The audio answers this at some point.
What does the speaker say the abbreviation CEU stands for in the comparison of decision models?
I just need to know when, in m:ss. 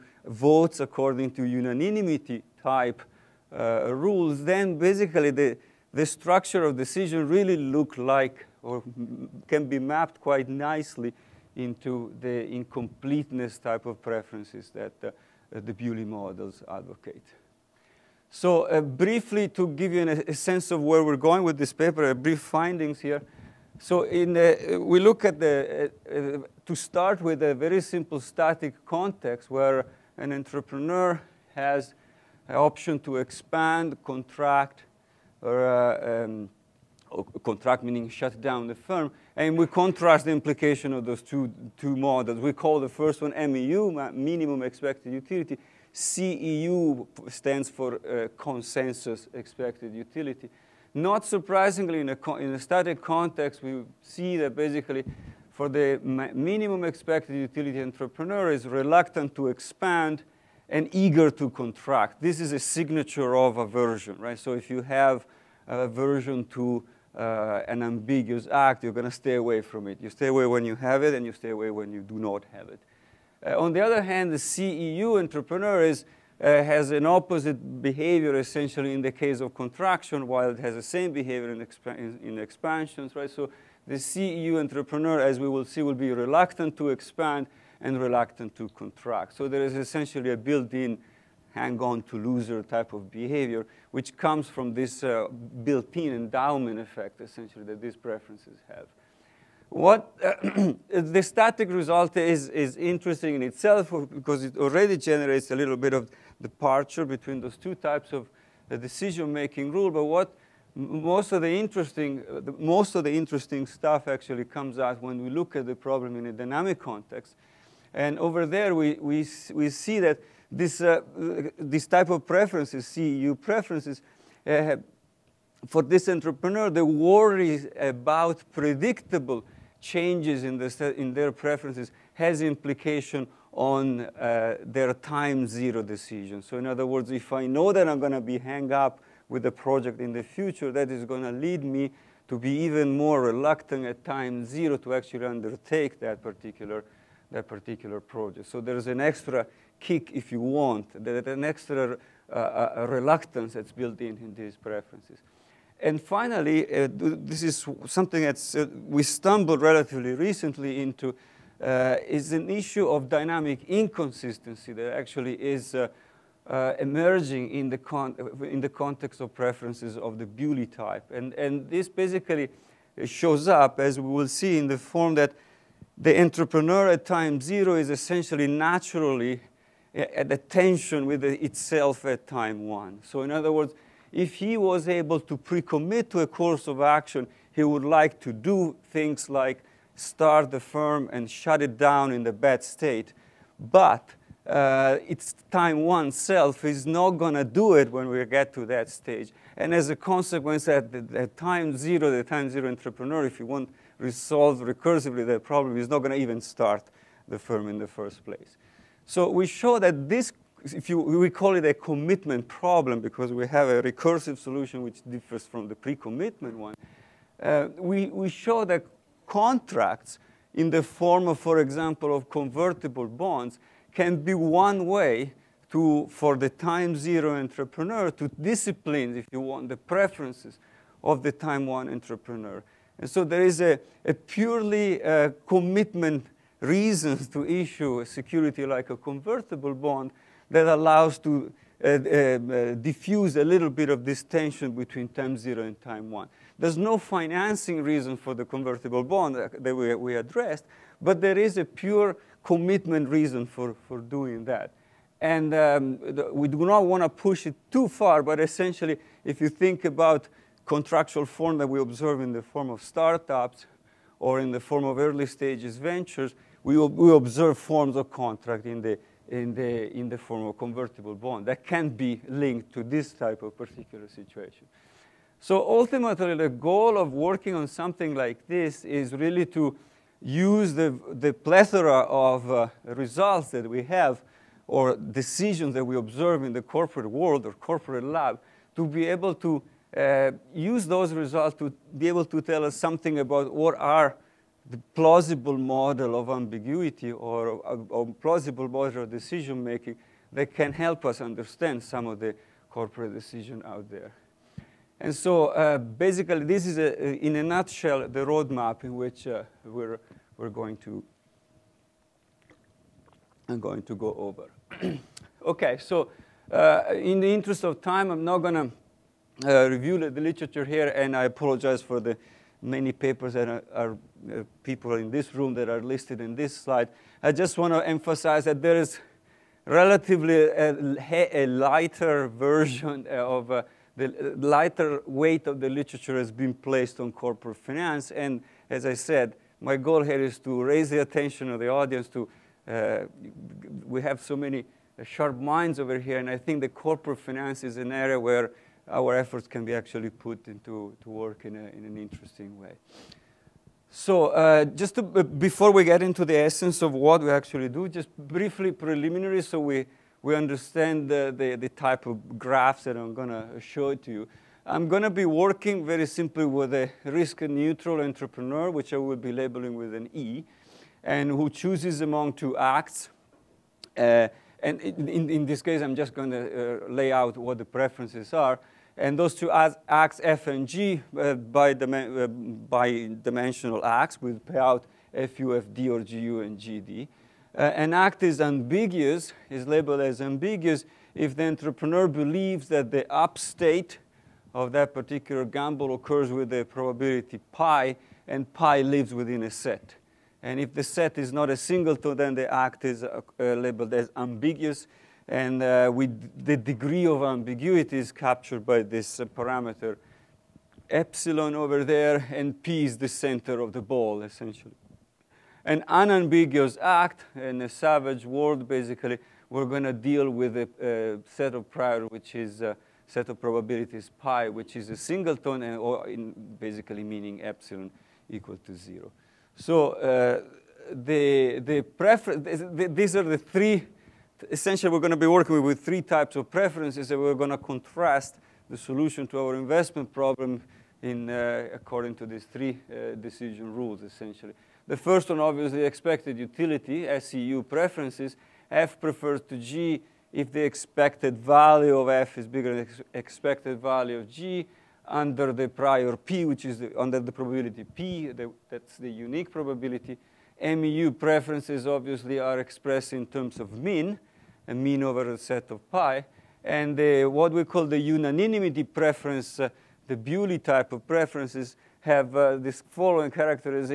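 0:48.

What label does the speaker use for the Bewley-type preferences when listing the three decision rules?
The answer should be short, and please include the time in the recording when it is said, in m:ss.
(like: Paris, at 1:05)
unanimity preference, at 7:47.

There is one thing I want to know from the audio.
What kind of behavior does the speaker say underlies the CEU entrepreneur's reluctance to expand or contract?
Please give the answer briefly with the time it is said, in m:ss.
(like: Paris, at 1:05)
hang-on to loser, at 1:31.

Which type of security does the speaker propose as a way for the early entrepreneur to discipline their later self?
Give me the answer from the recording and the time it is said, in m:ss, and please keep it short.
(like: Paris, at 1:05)
convertible bonds, at 3:42.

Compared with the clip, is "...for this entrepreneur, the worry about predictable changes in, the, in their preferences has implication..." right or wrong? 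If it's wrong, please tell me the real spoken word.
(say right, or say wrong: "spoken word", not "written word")
right.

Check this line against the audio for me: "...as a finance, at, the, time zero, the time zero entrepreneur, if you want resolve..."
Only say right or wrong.
wrong.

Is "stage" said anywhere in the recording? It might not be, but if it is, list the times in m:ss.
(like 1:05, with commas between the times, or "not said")
3:18, 4:25.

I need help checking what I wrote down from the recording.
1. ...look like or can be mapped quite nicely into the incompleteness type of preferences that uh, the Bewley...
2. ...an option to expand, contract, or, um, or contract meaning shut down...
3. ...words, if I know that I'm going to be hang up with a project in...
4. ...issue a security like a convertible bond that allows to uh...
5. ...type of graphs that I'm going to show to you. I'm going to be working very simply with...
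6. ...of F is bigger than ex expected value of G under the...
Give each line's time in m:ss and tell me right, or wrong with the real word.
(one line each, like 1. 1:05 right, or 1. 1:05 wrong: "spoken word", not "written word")
1. 0:07 right
2. 0:32 right
3. 2:16 right
4. 3:57 right
5. 6:01 right
6. 7:31 right.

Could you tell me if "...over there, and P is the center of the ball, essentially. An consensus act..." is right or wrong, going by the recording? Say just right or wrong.
wrong.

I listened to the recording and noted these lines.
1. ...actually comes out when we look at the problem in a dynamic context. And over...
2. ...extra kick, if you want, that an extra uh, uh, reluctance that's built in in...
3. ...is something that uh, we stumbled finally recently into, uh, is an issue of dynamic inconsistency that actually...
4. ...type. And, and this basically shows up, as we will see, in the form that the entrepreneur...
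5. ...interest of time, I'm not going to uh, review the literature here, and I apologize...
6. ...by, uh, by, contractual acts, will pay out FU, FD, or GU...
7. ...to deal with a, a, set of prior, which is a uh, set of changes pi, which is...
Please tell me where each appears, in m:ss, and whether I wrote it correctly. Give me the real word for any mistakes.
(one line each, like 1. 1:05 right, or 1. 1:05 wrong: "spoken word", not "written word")
1. 1:54 right
2. 2:29 right
3. 2:37 wrong: "relatively", not "finally"
4. 2:50 right
5. 5:17 right
6. 6:21 wrong: "dimensional", not "contractual"
7. 6:59 wrong: "probabilities", not "changes".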